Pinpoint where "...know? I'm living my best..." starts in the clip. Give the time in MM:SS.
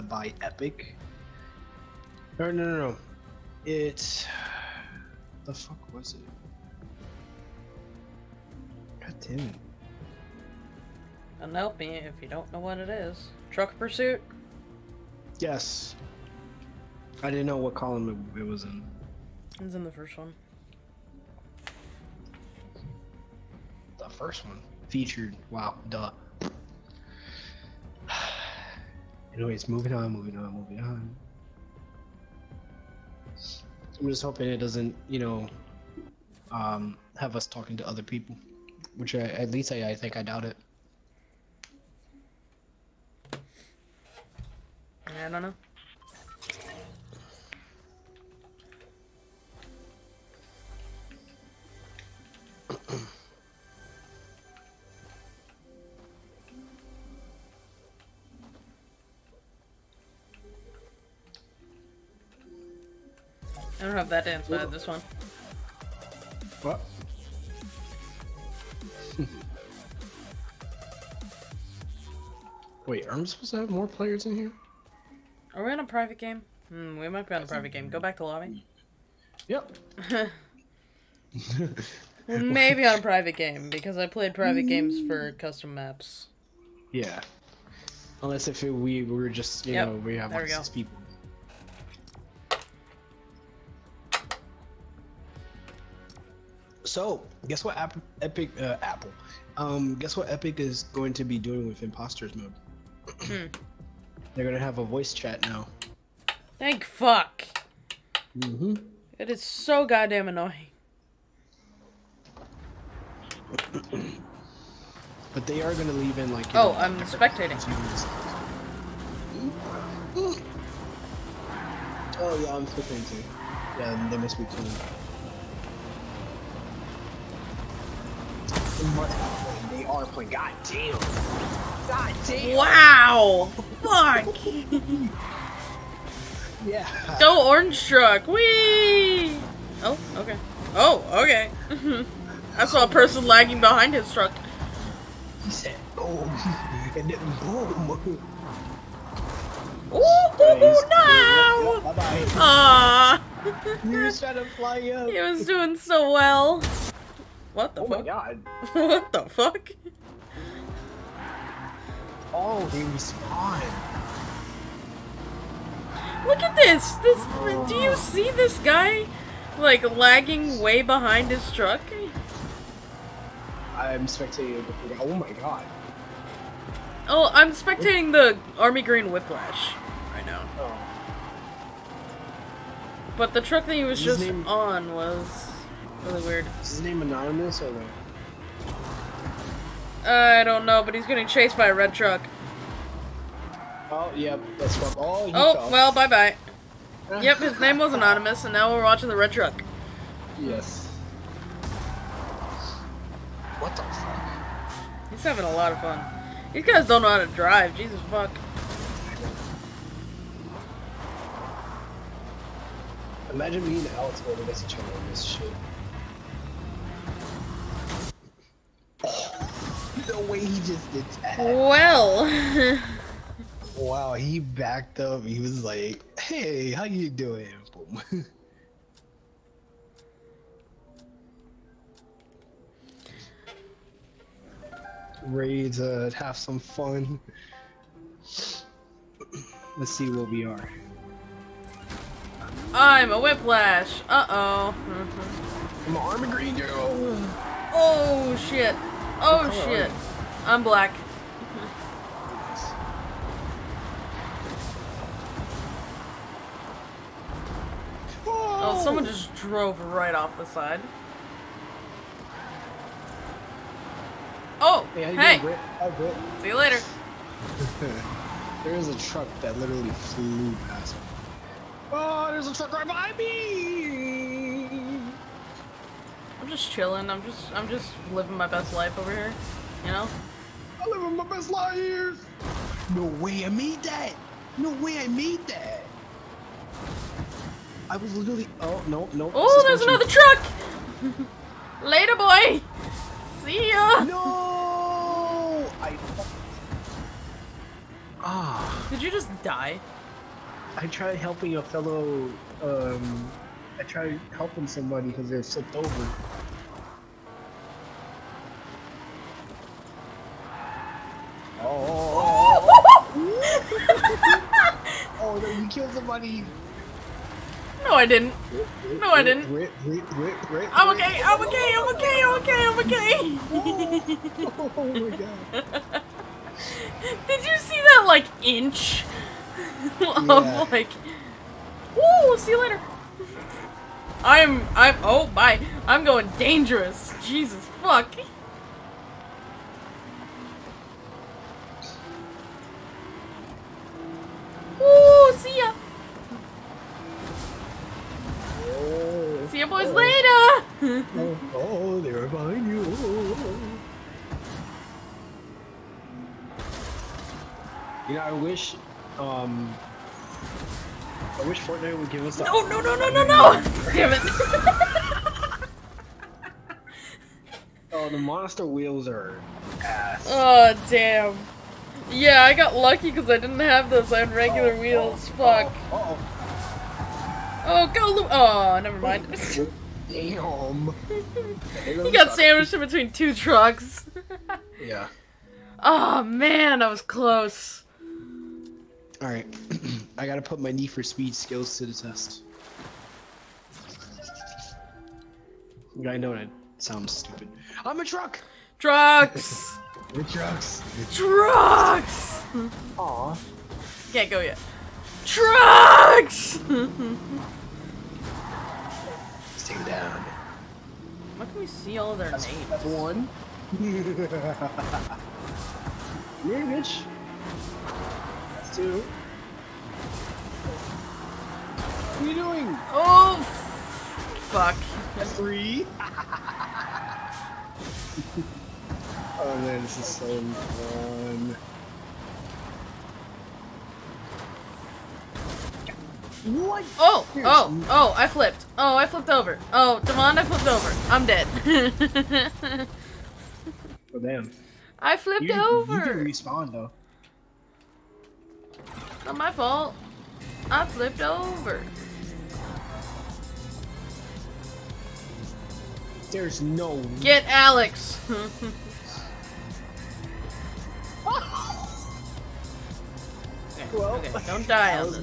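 04:39.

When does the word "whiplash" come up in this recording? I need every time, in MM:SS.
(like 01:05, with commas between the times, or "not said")
02:59, 04:03.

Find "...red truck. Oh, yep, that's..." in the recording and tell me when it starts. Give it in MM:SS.
03:11.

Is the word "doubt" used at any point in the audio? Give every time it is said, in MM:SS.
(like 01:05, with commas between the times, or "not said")
00:40.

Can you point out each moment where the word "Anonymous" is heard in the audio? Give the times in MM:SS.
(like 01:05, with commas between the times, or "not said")
03:07, 03:17.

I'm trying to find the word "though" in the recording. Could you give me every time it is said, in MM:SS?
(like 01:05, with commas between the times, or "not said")
07:26.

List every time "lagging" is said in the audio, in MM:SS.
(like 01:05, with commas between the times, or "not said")
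02:23, 02:49.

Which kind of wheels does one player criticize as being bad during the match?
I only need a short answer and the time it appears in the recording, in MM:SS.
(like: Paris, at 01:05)
Monster wheels, at 06:08.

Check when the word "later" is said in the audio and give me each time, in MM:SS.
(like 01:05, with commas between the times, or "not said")
04:26, 04:51, 05:32, 05:49.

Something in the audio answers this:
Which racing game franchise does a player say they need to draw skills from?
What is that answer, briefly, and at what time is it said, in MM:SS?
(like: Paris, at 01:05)
Need for Speed, at 06:30.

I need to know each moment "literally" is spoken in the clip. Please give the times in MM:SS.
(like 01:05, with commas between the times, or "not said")
04:29, 04:48.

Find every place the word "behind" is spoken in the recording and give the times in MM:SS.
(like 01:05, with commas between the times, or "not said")
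02:23, 02:50, 04:32, 05:52.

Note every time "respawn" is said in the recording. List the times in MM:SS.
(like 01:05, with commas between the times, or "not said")
02:42, 07:26.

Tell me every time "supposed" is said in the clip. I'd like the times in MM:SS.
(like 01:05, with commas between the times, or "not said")
01:13.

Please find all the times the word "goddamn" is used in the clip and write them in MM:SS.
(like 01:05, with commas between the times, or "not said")
01:49.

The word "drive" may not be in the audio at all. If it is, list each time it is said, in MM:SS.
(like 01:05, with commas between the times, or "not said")
03:27.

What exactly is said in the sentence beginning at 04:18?
Oh, someone just drove right off the side.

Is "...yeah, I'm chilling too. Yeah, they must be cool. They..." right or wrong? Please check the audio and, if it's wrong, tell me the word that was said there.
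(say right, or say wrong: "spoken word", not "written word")
wrong: "spectating", not "chilling".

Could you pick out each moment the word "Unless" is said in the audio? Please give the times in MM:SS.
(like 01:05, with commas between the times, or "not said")
01:28.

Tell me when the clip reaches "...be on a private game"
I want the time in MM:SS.
01:17.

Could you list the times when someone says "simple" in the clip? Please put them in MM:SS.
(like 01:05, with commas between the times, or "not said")
not said.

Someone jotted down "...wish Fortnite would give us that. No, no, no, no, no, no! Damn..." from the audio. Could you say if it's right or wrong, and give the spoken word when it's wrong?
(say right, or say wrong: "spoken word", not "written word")
right.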